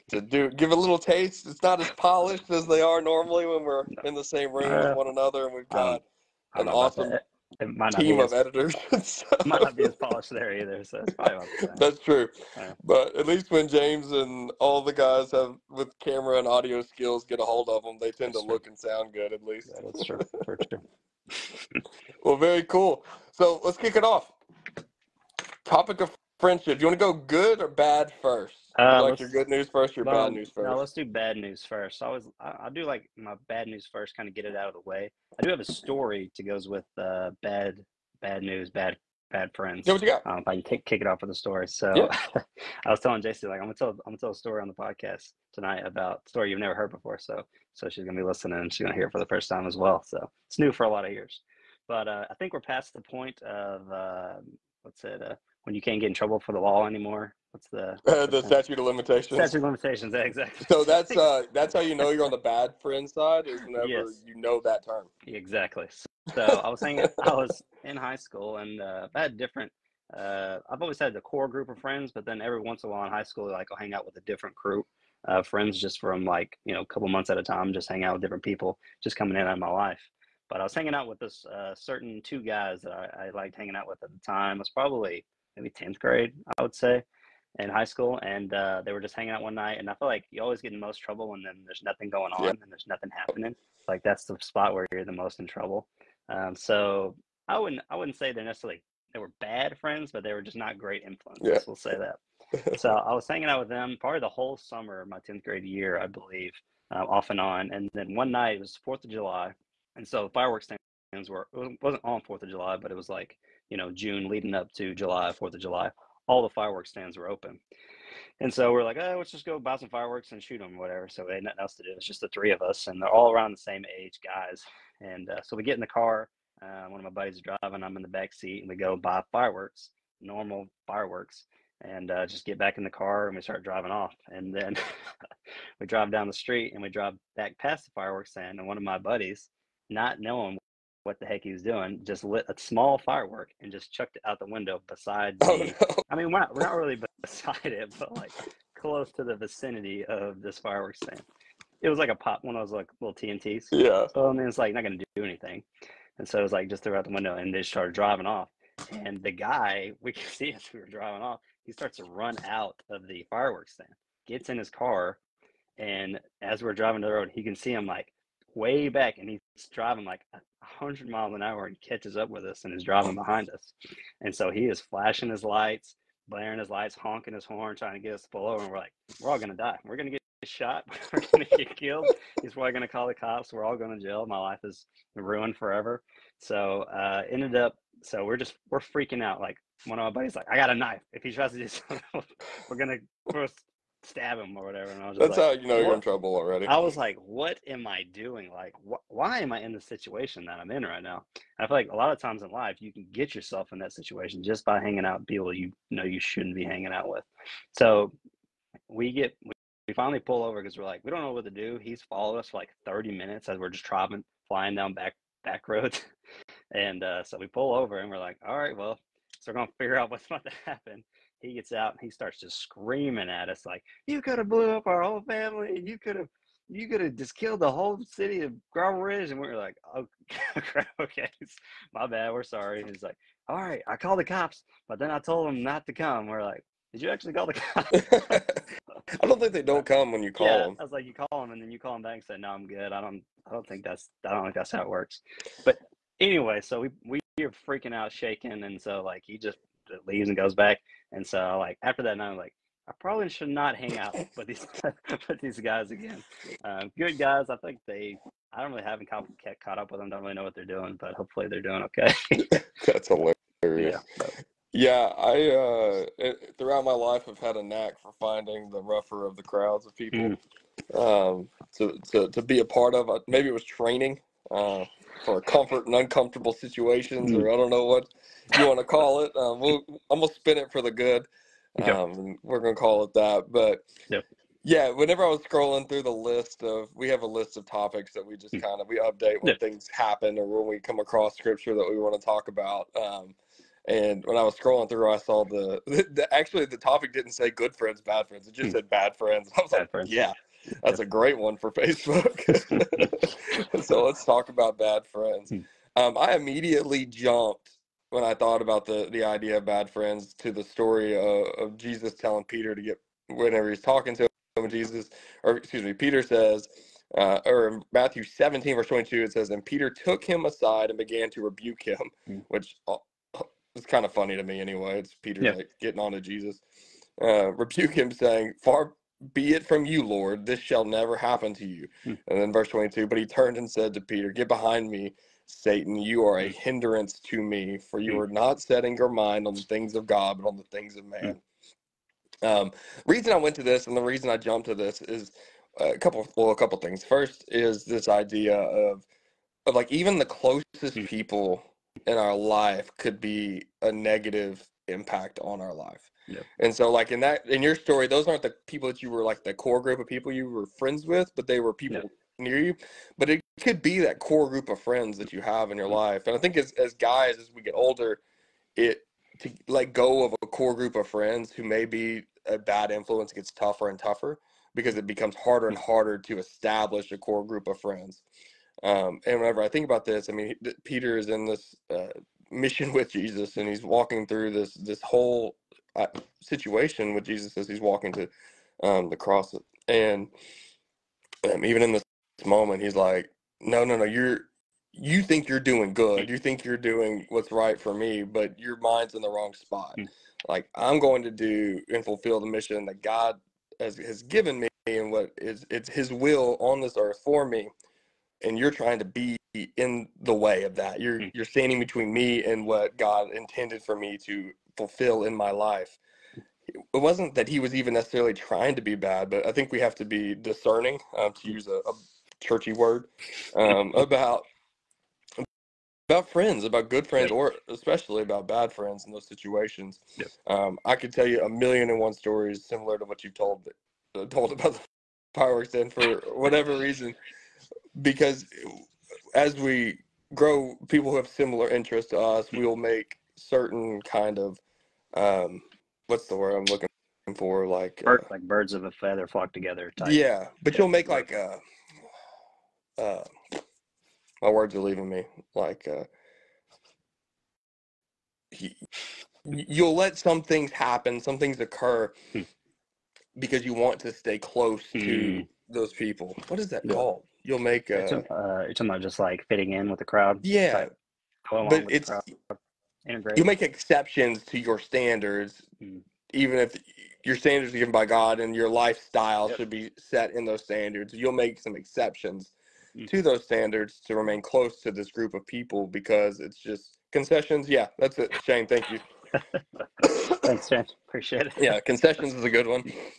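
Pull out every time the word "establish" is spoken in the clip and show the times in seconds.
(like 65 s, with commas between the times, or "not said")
376 s.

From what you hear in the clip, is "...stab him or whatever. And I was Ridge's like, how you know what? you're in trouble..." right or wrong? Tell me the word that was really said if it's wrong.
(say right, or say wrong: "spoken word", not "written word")
wrong: "That", not "Ridge".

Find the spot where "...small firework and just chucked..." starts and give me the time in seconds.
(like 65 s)
142 s.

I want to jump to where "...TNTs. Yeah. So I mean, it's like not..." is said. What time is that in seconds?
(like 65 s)
153 s.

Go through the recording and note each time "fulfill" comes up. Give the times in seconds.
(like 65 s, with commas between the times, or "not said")
402 s, 414 s.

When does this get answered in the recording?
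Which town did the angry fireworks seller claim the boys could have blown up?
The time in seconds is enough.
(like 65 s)
228 s.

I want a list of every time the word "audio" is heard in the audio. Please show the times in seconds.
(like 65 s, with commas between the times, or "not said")
16 s.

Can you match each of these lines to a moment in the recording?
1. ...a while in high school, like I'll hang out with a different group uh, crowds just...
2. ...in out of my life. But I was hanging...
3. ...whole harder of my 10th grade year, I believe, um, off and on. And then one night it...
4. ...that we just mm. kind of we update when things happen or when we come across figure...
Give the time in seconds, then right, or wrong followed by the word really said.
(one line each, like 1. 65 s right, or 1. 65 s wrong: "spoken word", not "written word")
1. 72 s wrong: "friends", not "crowds"
2. 79 s right
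3. 104 s wrong: "summer", not "harder"
4. 288 s wrong: "scripture", not "figure".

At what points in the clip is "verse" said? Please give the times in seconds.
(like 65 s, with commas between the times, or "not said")
318 s, 332 s.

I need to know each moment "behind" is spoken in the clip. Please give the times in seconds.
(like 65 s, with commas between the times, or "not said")
173 s, 334 s.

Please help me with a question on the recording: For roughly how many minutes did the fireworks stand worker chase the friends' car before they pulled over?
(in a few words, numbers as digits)
30.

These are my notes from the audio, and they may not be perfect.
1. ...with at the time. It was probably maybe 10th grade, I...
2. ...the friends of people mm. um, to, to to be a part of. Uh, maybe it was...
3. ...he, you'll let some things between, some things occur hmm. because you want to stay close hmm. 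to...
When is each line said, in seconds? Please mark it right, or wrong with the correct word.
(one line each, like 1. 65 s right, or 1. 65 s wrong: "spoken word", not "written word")
1. 83 s right
2. 269 s wrong: "crowds", not "friends"
3. 458 s wrong: "happen", not "between".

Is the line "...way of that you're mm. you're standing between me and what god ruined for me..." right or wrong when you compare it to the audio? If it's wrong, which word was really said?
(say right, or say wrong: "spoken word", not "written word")
wrong: "intended", not "ruined".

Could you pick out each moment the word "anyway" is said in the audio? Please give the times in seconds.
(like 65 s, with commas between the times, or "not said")
246 s, 324 s.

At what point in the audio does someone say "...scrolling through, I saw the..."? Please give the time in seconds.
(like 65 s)
294 s.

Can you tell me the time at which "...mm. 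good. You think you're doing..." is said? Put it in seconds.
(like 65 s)
395 s.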